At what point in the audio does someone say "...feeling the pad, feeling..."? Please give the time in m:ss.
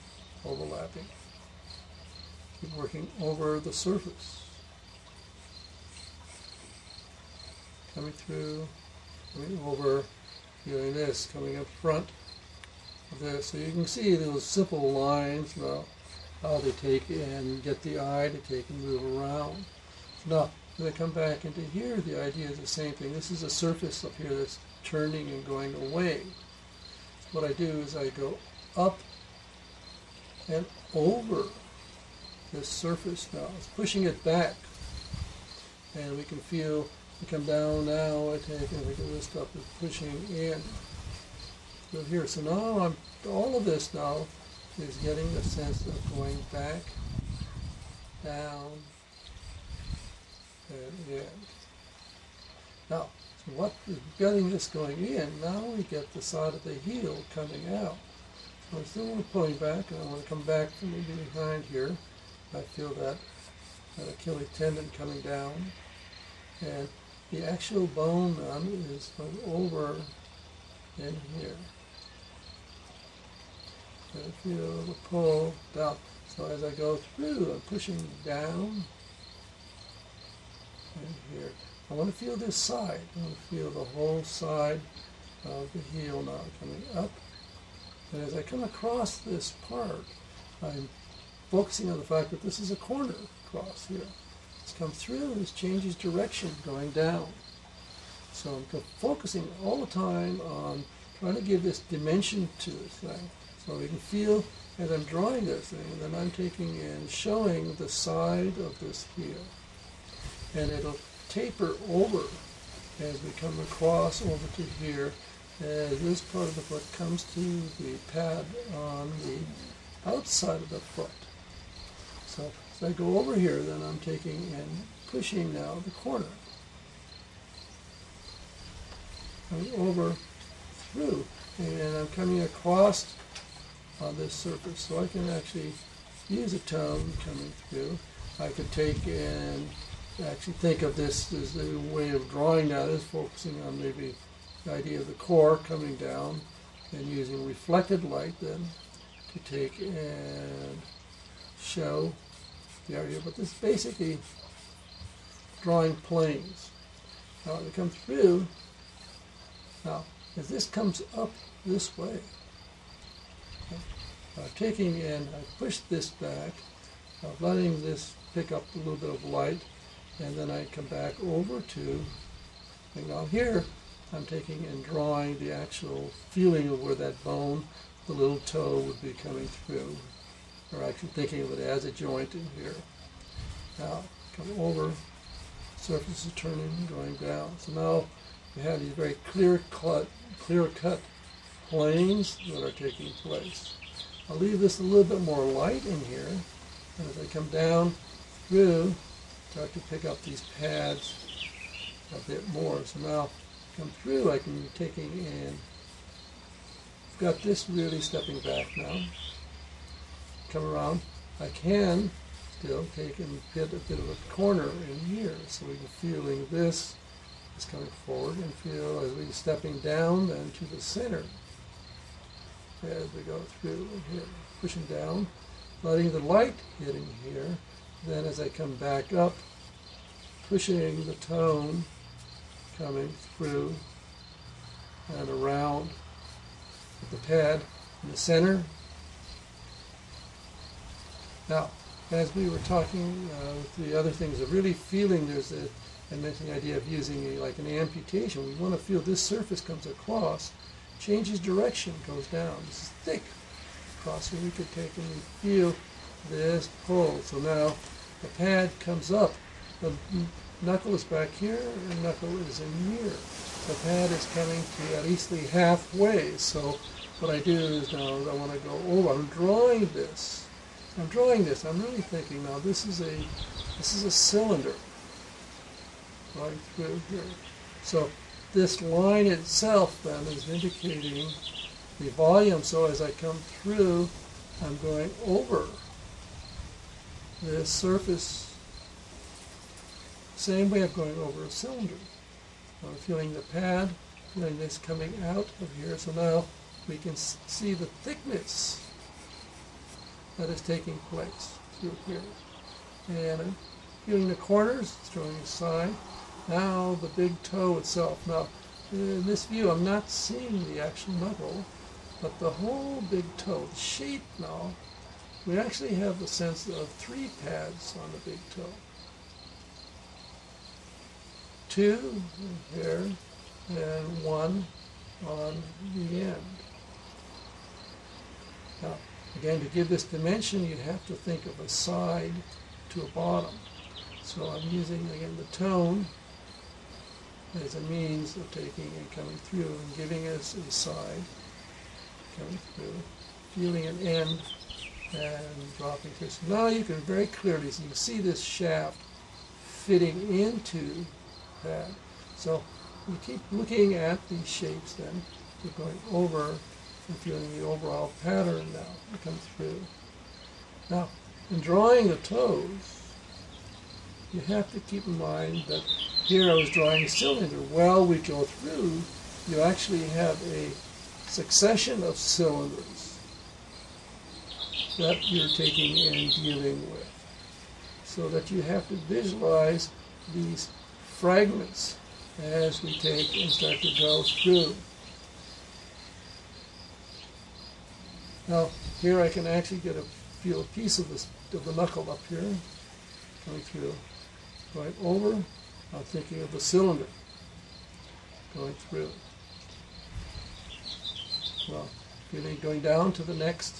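4:52.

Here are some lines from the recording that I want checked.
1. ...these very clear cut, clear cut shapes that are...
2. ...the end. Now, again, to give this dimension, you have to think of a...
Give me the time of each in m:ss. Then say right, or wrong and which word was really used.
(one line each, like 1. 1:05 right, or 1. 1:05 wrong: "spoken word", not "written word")
1. 3:08 wrong: "planes", not "shapes"
2. 5:25 right.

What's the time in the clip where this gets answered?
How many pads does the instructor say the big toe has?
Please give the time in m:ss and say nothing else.
5:16.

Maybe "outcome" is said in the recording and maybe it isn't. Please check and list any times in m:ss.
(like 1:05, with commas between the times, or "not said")
not said.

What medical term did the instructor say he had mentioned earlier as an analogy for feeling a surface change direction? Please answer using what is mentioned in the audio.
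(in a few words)
amputation.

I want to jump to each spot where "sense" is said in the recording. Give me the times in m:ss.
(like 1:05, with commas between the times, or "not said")
0:45, 5:16.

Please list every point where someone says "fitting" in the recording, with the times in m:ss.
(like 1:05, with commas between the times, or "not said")
5:49.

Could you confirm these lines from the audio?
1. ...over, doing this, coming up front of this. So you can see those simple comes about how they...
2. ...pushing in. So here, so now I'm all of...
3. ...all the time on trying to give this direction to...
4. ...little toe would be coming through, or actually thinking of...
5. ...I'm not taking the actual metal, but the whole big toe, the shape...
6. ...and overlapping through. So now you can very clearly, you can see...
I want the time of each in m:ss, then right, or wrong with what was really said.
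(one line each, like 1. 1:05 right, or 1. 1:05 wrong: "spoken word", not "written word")
1. 0:09 wrong: "lines", not "comes"
2. 0:39 right
3. 1:39 wrong: "dimension", not "direction"
4. 2:58 right
5. 5:09 wrong: "seeing", not "taking"
6. 5:45 wrong: "dropping", not "overlapping".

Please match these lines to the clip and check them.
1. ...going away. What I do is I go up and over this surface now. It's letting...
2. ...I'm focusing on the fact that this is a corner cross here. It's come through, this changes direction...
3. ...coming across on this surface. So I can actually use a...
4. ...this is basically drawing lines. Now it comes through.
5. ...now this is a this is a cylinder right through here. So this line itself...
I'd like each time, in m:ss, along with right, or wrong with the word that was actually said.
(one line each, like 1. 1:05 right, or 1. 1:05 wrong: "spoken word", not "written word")
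1. 0:25 wrong: "pushing", not "letting"
2. 1:30 right
3. 2:12 right
4. 2:33 wrong: "planes", not "lines"
5. 4:32 right.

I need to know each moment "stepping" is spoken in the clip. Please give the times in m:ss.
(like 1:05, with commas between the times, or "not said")
3:28, 3:39.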